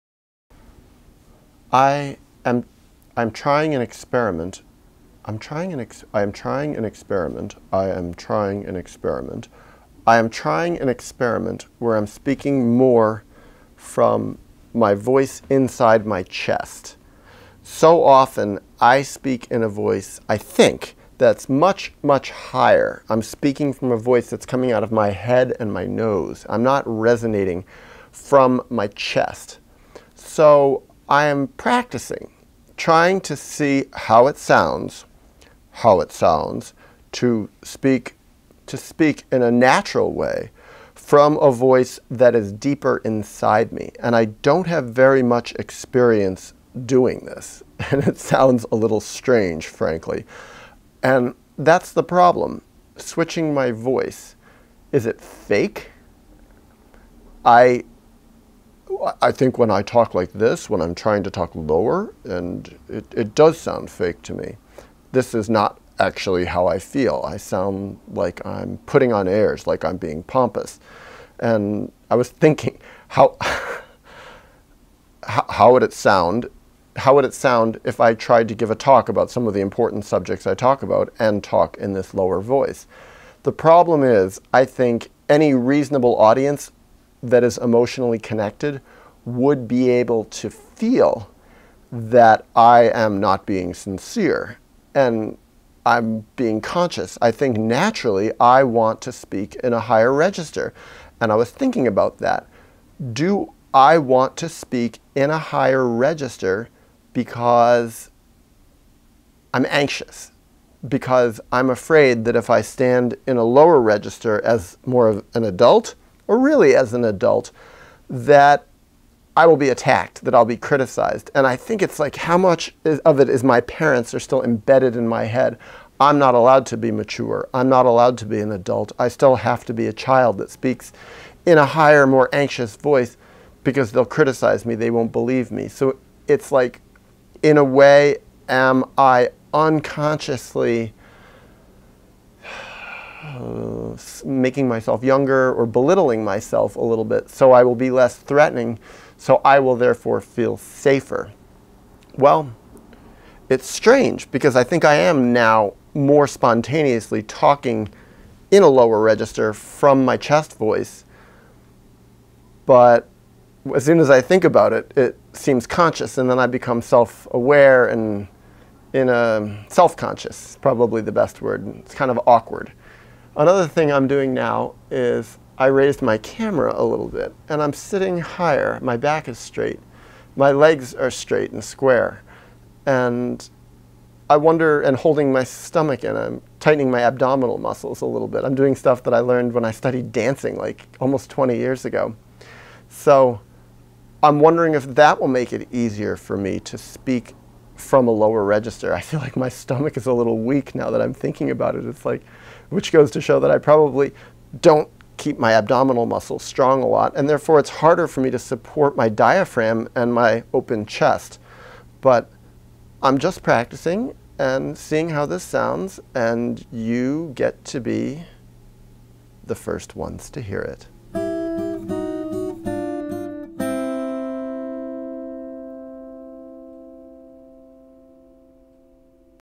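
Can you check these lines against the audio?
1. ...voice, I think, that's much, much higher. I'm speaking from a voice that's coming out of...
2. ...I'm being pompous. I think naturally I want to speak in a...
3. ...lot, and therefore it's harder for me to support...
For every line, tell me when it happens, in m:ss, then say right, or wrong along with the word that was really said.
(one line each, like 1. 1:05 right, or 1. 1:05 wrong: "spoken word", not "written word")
1. 0:19 right
2. 1:35 wrong: "conscious", not "pompous"
3. 3:26 right.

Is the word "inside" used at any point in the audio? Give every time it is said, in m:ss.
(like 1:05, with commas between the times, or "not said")
0:15, 0:43.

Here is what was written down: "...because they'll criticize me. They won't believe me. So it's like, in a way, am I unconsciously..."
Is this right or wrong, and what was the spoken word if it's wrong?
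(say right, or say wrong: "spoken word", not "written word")
right.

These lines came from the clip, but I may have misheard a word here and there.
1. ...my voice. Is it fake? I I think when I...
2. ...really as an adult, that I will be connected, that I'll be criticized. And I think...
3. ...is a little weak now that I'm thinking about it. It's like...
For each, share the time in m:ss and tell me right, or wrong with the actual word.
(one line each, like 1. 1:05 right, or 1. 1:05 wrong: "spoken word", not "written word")
1. 0:53 right
2. 1:56 wrong: "attacked", not "connected"
3. 3:19 right.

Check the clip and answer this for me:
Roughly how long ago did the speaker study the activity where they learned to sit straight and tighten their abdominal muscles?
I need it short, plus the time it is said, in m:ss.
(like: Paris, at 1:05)
almost 20 years ago, at 3:10.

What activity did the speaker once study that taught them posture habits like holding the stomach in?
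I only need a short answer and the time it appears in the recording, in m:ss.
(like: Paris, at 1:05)
dancing, at 3:10.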